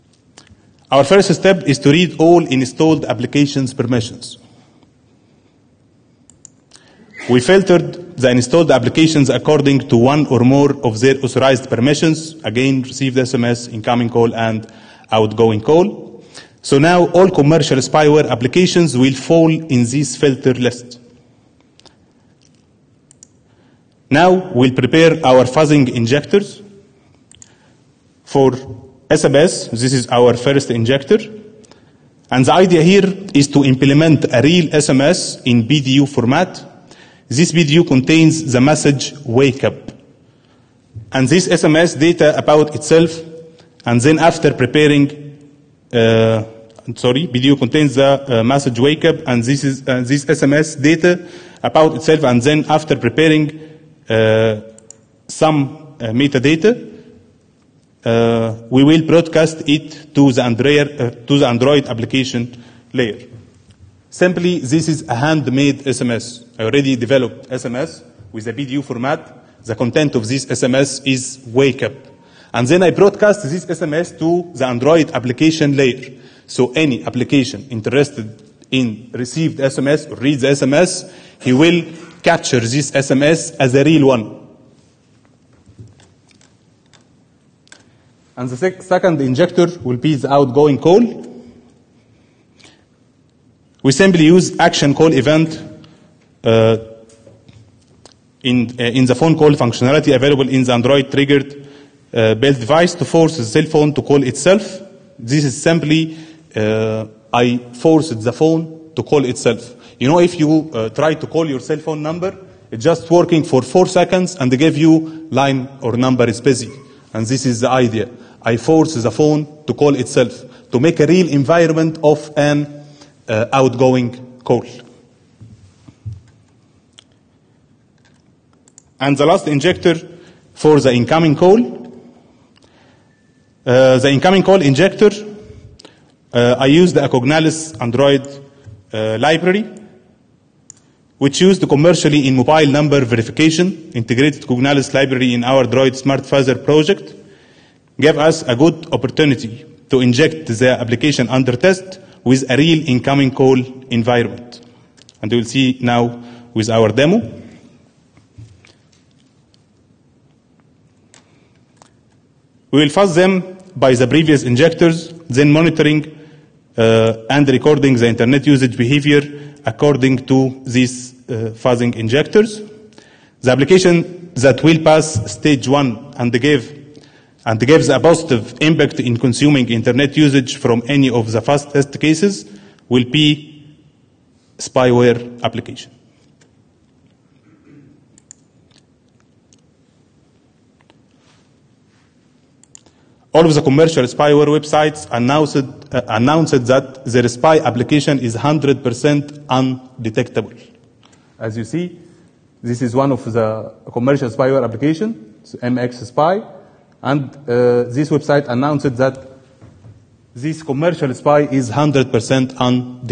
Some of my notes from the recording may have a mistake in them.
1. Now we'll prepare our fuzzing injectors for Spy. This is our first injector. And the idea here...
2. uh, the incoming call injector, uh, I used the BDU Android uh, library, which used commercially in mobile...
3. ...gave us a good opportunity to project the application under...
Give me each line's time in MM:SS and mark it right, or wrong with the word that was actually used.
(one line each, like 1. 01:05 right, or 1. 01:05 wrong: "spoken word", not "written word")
1. 00:24 wrong: "SMS", not "Spy"
2. 02:13 wrong: "Acognalis", not "BDU"
3. 02:28 wrong: "inject", not "project".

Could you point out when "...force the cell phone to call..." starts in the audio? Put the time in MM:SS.
01:43.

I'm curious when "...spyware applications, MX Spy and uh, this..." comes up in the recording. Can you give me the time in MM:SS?
03:24.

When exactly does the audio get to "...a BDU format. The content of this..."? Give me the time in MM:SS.
01:08.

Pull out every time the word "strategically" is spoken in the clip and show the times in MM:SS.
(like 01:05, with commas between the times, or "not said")
not said.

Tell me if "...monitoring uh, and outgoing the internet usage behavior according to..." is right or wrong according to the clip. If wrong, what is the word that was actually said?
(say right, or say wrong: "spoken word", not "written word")
wrong: "recording", not "outgoing".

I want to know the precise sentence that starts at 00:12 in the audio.
Again, received SMS, incoming call, and outgoing call.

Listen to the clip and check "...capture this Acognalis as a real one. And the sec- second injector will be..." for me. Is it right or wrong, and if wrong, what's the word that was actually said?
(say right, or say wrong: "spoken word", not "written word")
wrong: "SMS", not "Acognalis".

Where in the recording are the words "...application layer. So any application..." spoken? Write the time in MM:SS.
01:15.